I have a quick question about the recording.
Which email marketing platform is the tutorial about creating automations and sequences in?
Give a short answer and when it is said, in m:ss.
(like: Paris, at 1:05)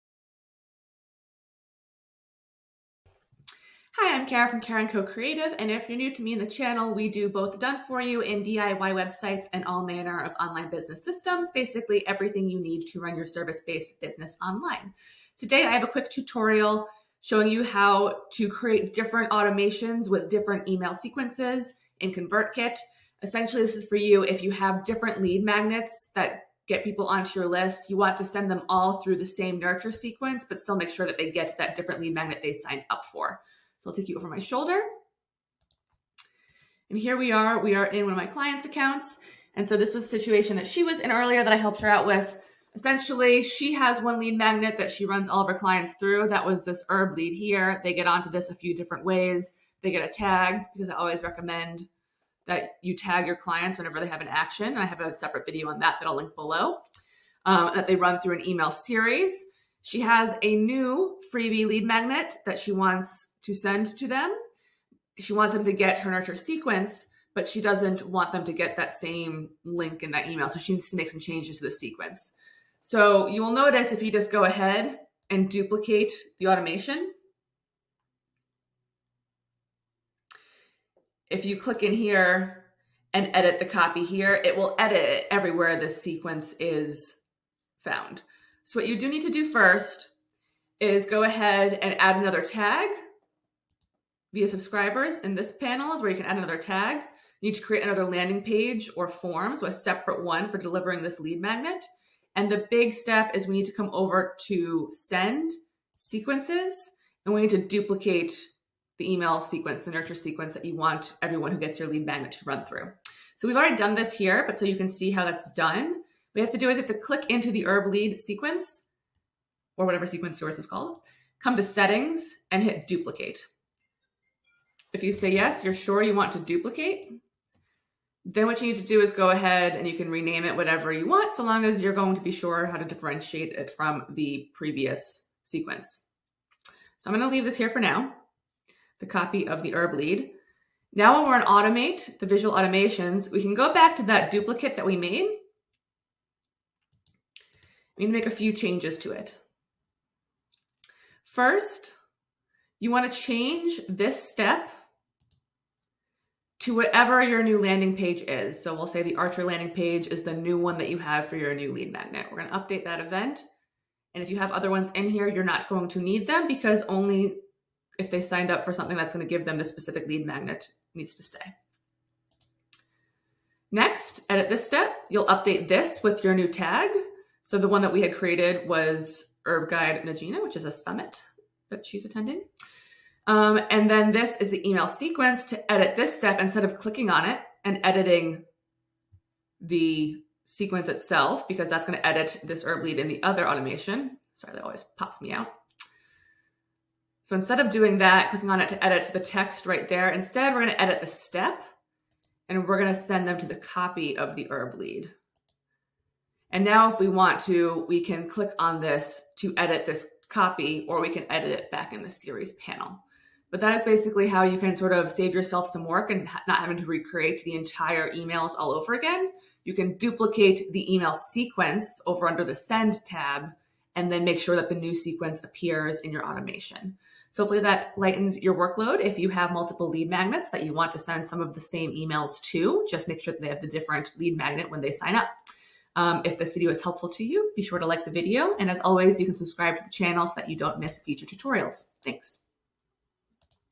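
ConvertKit, at 0:22.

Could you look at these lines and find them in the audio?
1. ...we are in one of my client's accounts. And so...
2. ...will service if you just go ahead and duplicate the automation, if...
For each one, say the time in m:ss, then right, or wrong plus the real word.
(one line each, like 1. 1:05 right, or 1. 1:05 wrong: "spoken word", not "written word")
1. 0:37 right
2. 1:13 wrong: "notice", not "service".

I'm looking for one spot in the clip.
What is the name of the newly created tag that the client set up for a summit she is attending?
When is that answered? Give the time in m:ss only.
2:59.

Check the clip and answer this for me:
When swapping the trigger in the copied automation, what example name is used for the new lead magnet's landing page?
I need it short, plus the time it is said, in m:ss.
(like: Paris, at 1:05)
Archer, at 2:39.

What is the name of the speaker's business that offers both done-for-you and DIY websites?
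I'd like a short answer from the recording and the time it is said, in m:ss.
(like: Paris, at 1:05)
Karen Co Creative, at 0:04.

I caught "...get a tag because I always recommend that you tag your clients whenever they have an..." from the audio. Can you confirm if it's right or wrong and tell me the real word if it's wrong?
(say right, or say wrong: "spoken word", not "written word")
right.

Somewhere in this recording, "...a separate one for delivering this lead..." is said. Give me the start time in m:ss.
1:39.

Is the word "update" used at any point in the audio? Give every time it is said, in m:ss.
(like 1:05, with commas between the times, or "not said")
2:42, 2:55.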